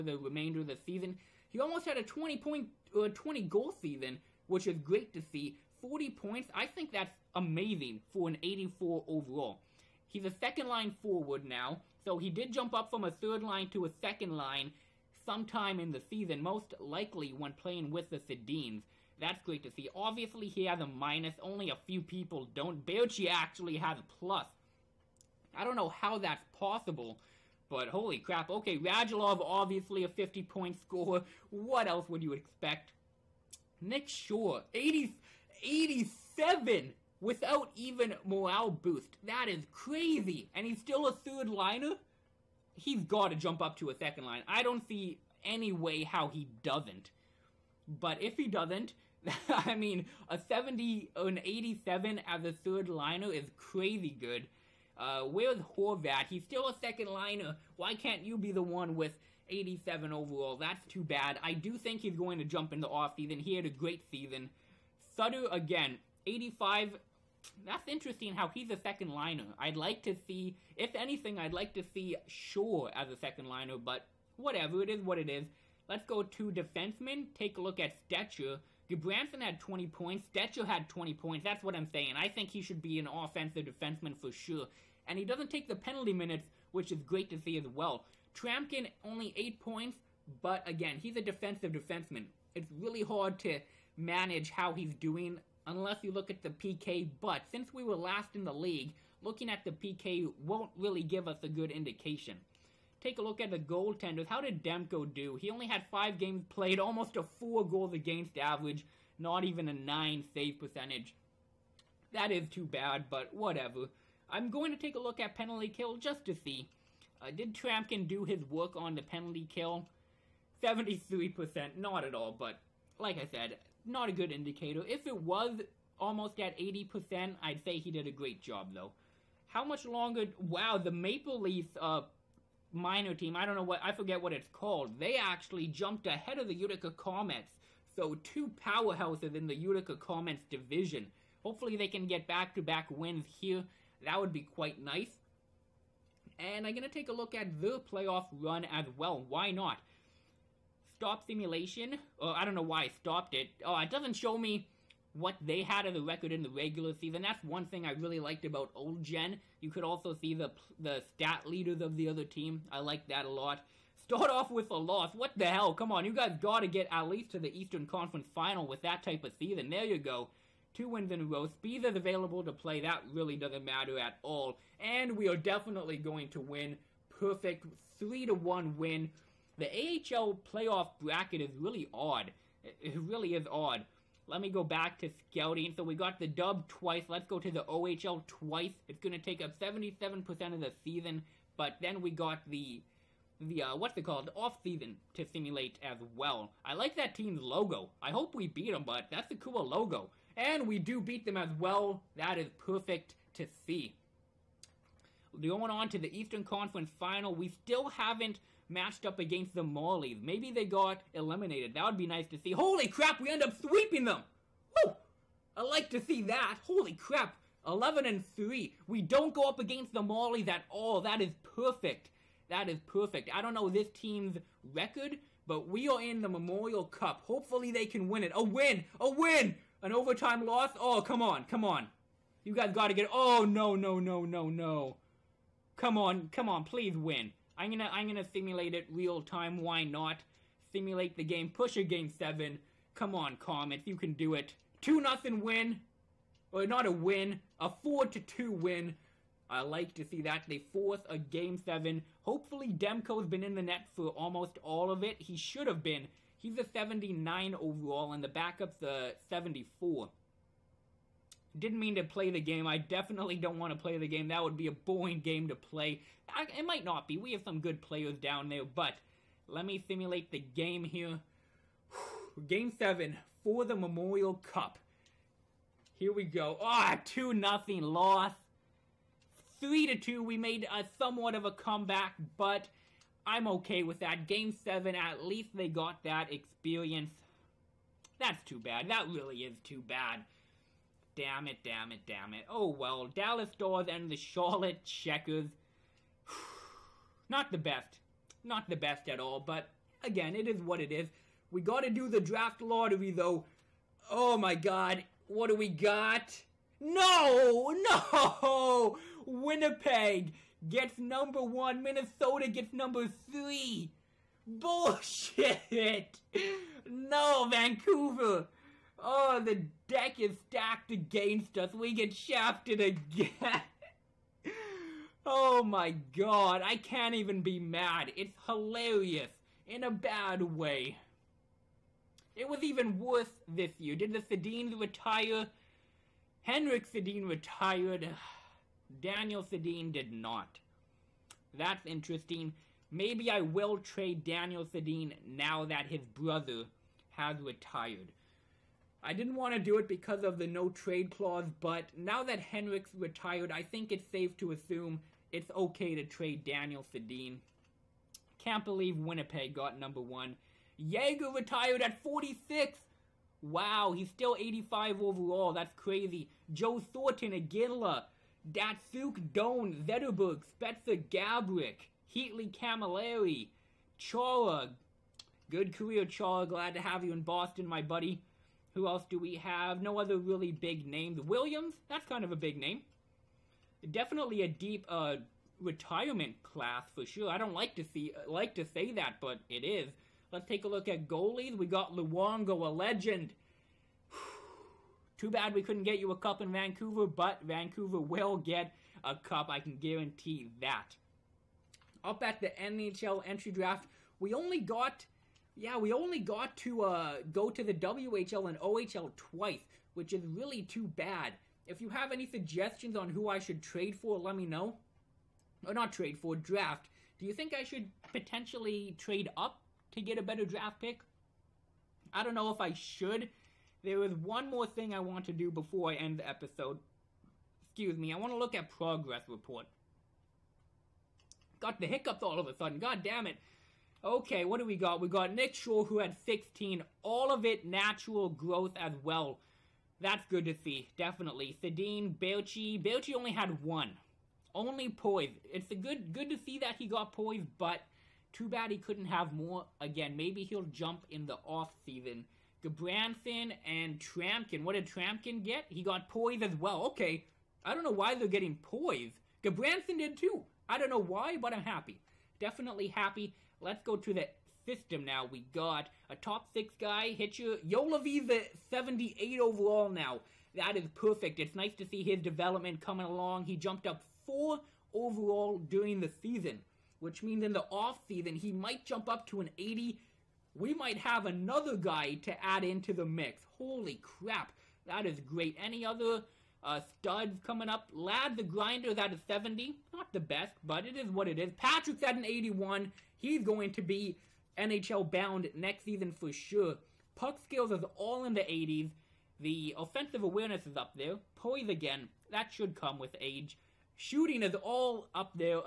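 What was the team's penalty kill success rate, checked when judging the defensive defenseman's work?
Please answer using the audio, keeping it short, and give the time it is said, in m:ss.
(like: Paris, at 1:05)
73%, at 2:00.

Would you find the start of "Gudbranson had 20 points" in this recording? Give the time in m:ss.
1:18.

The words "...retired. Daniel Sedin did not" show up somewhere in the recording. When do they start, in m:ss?
5:37.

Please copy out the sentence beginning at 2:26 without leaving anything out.
And I'm going to take a look at the playoff run as well.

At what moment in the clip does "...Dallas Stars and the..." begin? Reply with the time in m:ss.
4:53.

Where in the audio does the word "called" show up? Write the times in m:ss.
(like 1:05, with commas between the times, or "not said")
2:14, 3:14.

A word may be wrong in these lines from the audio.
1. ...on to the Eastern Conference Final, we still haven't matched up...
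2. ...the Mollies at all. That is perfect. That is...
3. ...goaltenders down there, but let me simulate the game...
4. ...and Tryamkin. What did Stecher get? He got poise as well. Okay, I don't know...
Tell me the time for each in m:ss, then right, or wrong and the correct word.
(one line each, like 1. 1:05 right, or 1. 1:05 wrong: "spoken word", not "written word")
1. 3:25 right
2. 3:39 right
3. 4:27 wrong: "players", not "goaltenders"
4. 7:33 wrong: "Tryamkin", not "Stecher".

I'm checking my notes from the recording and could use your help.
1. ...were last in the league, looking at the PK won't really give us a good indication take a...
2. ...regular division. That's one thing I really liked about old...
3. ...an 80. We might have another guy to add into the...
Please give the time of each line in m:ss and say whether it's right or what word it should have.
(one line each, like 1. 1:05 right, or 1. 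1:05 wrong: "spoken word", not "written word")
1. 1:37 right
2. 2:36 wrong: "season", not "division"
3. 7:59 right.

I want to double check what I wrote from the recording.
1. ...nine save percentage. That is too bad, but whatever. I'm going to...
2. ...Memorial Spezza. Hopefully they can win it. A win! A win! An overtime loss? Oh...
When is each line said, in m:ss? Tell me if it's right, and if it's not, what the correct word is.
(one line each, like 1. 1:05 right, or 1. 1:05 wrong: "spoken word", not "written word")
1. 1:49 right
2. 3:46 wrong: "Cup", not "Spezza".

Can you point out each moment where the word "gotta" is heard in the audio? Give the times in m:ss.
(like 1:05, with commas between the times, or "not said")
3:52, 5:01.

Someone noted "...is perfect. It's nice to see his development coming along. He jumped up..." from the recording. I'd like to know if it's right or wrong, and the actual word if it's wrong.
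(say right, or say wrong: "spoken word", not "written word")
right.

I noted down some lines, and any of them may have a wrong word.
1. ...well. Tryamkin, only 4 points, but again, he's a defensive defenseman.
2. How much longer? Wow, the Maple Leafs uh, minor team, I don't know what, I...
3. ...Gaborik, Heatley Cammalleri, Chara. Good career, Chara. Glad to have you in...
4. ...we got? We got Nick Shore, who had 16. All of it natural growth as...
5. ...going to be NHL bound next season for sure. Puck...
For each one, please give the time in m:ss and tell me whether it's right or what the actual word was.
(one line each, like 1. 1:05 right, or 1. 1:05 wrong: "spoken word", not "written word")
1. 1:27 wrong: "8", not "4"
2. 2:09 right
3. 6:11 right
4. 7:14 right
5. 8:13 right.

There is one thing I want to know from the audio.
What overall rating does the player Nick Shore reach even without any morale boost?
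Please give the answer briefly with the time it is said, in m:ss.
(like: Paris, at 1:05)
87, at 0:35.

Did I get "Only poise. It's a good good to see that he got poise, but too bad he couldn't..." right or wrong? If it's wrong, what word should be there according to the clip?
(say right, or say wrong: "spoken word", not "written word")
right.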